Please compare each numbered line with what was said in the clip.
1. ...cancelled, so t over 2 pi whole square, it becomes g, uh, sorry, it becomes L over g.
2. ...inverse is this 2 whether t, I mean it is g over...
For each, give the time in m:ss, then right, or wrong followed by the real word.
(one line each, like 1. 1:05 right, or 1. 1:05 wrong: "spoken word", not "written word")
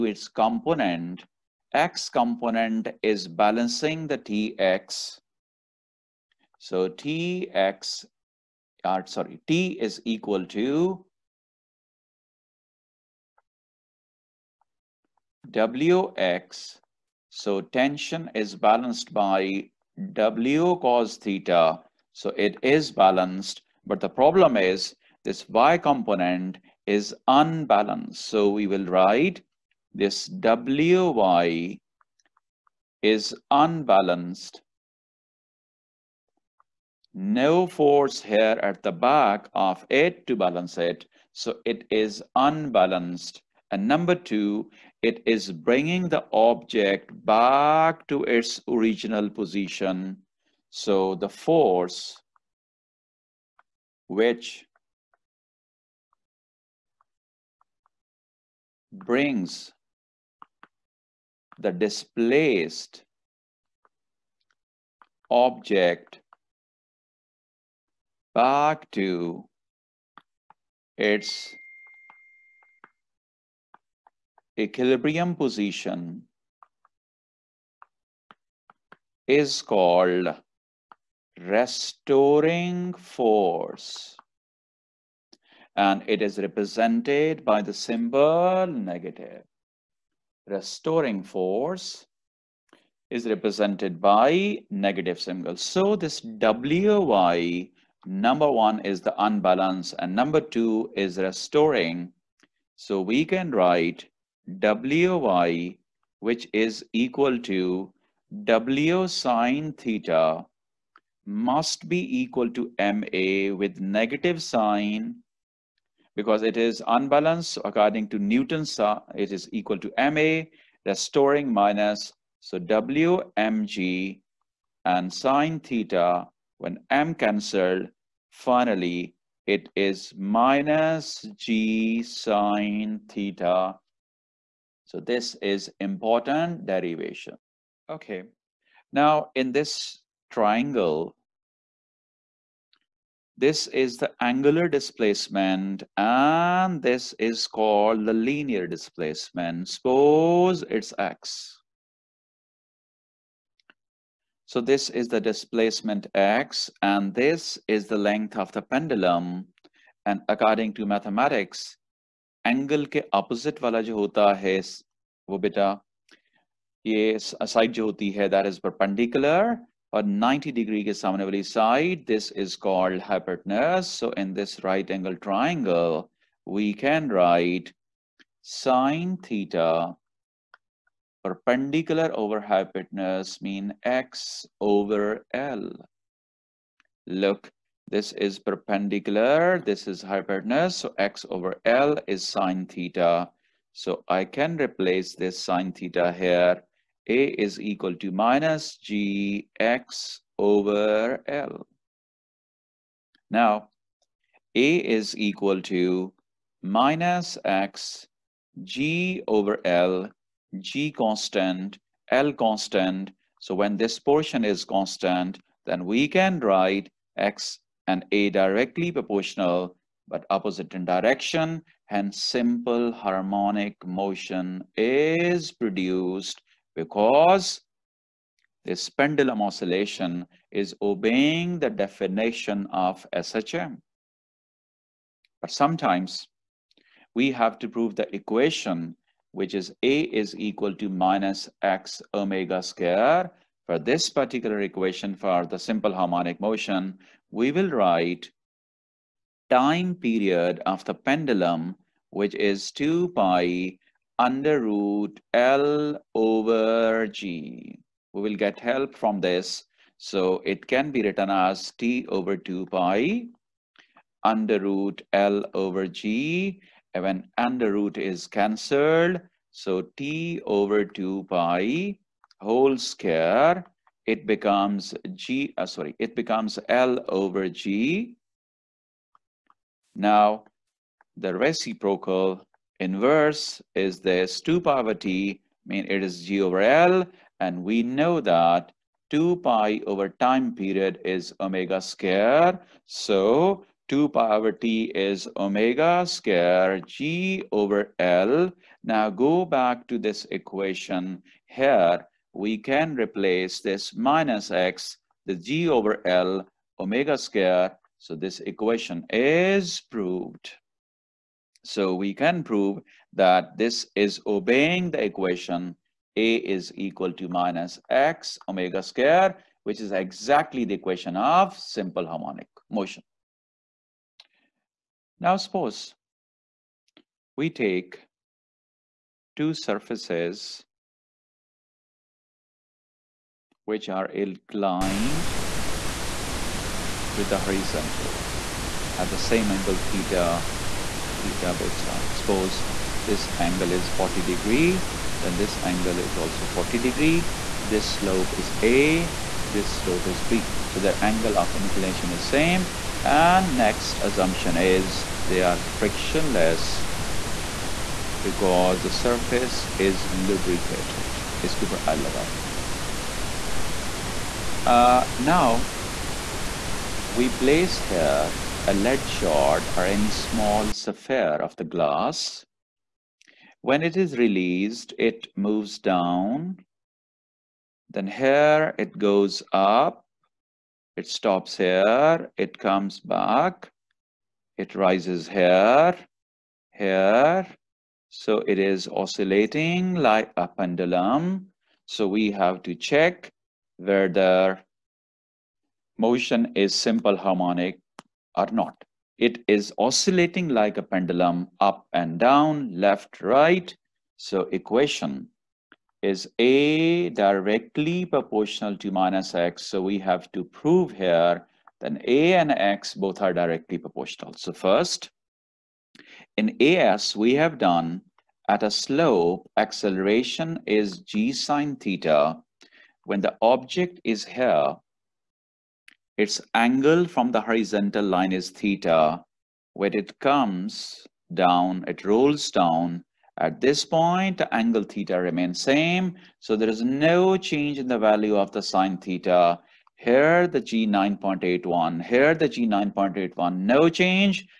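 1. 4:28 right
2. 4:42 wrong: "power", not "whether".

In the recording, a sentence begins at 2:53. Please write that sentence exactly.
So in this right angle triangle, we can write sine theta perpendicular over hypotenuse mean x over L.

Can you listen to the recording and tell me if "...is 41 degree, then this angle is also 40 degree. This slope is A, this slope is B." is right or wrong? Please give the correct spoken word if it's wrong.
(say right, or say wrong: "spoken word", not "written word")
wrong: "40", not "41".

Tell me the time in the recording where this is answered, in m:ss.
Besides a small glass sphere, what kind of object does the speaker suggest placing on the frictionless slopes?
6:08.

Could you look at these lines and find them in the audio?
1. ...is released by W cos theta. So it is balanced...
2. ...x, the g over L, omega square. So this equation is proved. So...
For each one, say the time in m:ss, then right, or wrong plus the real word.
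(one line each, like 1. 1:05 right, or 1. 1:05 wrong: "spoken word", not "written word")
1. 0:18 wrong: "balanced", not "released"
2. 5:04 right.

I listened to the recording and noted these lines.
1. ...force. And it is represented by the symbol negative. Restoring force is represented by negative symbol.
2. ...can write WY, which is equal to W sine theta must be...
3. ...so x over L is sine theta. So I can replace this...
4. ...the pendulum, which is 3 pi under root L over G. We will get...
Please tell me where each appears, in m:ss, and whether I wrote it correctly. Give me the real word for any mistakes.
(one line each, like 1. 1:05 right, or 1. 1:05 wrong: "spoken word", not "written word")
1. 1:22 right
2. 1:43 right
3. 3:10 right
4. 4:10 wrong: "2", not "3".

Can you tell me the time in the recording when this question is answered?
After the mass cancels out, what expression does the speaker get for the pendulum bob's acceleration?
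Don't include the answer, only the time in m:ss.
2:10.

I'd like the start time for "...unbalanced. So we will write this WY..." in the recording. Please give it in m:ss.
0:27.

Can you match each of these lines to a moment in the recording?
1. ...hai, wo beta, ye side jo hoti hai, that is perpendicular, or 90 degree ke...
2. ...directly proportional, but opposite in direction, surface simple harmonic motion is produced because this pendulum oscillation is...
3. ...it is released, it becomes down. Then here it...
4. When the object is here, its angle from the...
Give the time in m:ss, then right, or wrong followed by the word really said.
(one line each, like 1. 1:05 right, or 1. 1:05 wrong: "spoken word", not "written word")
1. 2:44 right
2. 3:38 wrong: "hence", not "surface"
3. 6:13 wrong: "moves", not "becomes"
4. 7:03 right.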